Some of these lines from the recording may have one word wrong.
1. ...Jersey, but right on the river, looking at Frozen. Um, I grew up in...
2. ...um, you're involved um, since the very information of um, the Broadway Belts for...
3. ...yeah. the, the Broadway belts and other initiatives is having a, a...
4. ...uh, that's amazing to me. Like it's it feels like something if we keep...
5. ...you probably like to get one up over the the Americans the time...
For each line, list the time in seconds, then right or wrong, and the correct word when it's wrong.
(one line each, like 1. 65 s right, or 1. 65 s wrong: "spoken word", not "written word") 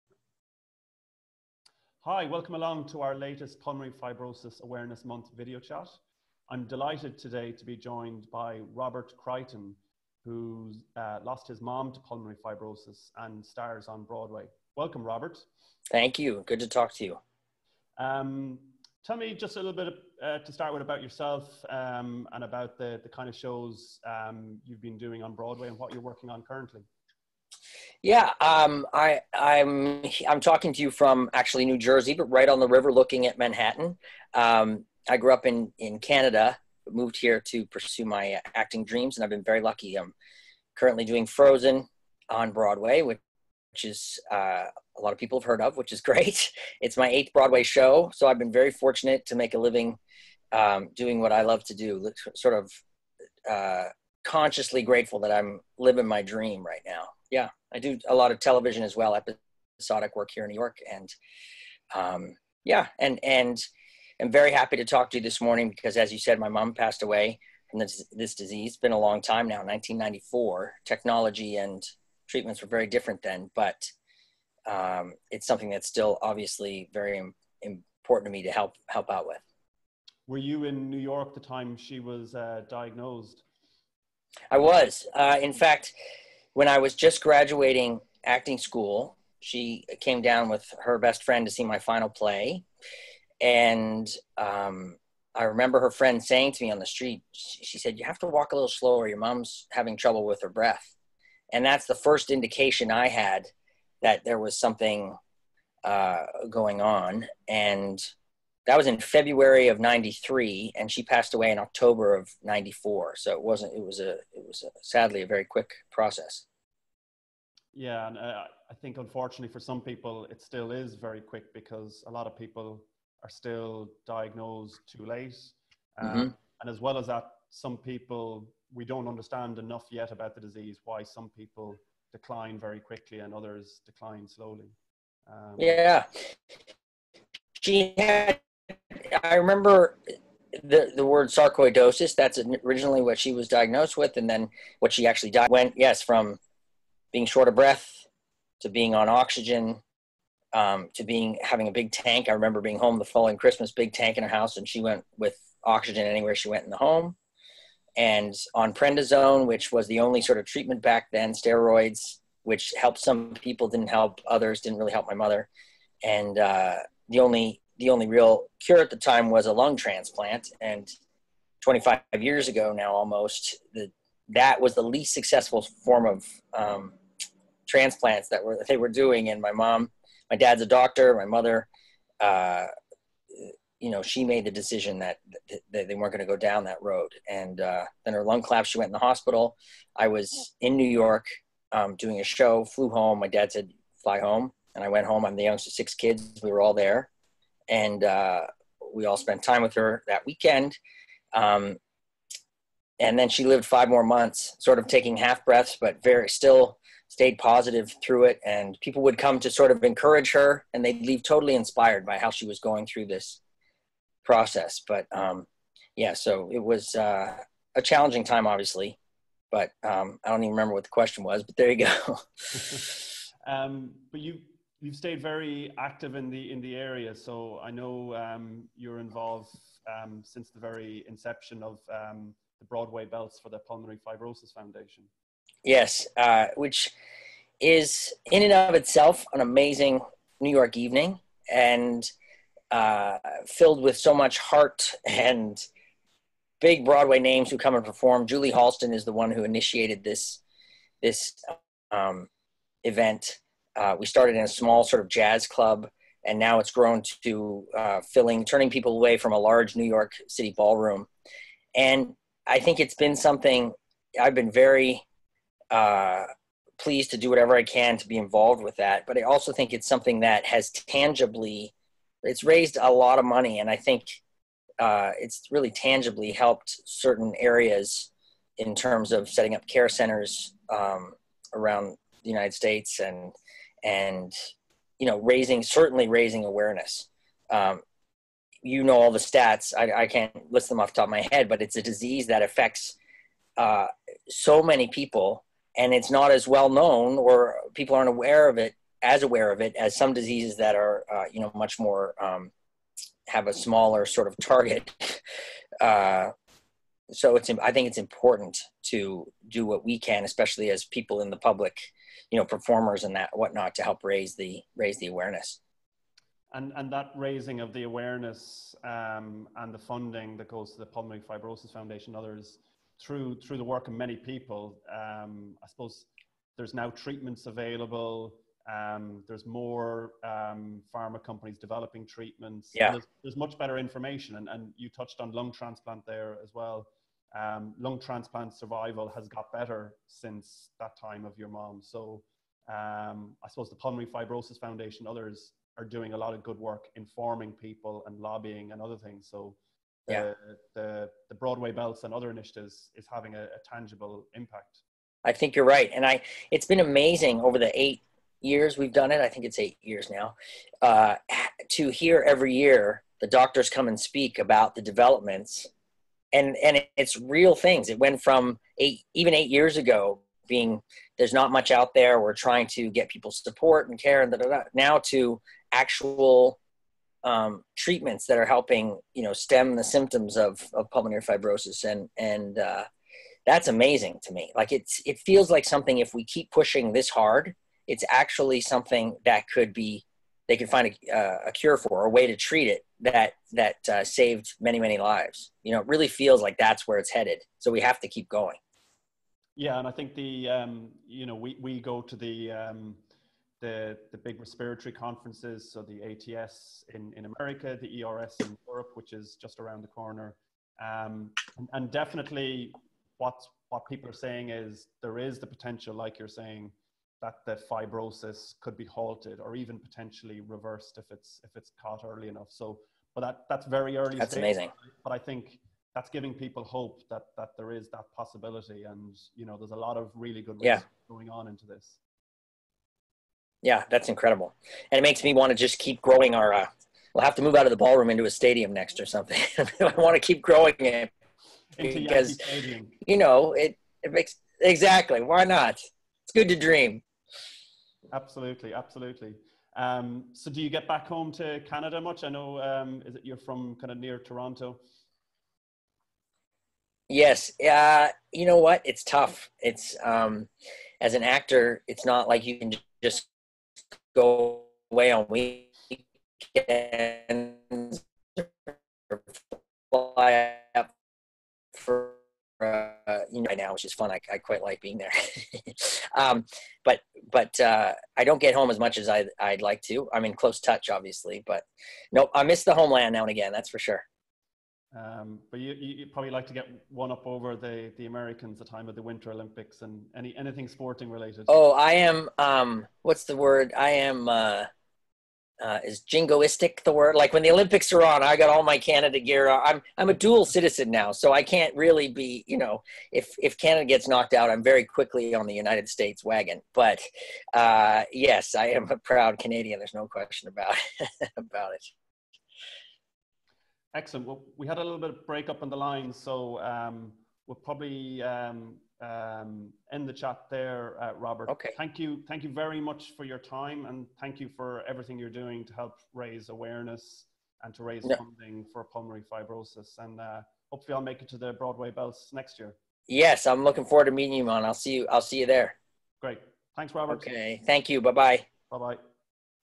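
1. 31 s wrong: "Manhattan", not "Frozen"
2. 228 s wrong: "inception", not "information"
3. 350 s right
4. 382 s right
5. 485 s right.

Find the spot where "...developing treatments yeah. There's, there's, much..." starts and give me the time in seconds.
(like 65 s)
331 s.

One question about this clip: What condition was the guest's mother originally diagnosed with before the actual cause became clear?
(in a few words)
sarcoidosis.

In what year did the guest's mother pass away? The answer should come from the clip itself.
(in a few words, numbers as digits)
1994.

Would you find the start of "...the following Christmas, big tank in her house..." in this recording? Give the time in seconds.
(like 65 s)
152 s.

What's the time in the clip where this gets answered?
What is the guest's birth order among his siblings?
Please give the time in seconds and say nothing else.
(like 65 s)
195 s.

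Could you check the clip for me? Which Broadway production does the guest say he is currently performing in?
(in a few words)
Frozen.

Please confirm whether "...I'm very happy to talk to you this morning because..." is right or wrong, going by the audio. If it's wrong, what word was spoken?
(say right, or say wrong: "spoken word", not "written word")
right.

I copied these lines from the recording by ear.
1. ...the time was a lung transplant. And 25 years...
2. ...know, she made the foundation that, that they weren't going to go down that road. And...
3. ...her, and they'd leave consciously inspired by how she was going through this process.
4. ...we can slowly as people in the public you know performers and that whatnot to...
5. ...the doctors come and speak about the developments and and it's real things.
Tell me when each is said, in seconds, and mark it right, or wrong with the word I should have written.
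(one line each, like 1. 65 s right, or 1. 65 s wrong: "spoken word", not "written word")
1. 168 s right
2. 183 s wrong: "decision", not "foundation"
3. 210 s wrong: "totally", not "consciously"
4. 309 s wrong: "especially", not "slowly"
5. 363 s right.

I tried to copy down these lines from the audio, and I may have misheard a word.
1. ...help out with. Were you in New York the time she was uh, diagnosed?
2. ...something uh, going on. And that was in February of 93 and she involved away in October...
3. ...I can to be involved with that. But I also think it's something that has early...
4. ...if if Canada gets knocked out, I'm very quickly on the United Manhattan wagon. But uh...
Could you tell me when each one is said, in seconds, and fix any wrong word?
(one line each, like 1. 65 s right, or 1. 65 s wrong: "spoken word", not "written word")
1. 78 s right
2. 104 s wrong: "passed", not "involved"
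3. 267 s wrong: "tangibly", not "early"
4. 503 s wrong: "States", not "Manhattan".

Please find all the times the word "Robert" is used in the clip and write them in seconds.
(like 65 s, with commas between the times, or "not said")
8 s, 15 s, 521 s, 536 s.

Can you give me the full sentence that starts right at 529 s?
And uh, hopefully I'll make it to the Broadway Belts next year.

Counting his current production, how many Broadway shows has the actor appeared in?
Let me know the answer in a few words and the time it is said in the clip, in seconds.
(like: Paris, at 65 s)
8th, at 47 s.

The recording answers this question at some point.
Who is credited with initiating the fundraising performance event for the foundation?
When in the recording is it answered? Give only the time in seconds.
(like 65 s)
248 s.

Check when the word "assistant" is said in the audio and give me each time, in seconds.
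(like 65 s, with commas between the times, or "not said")
not said.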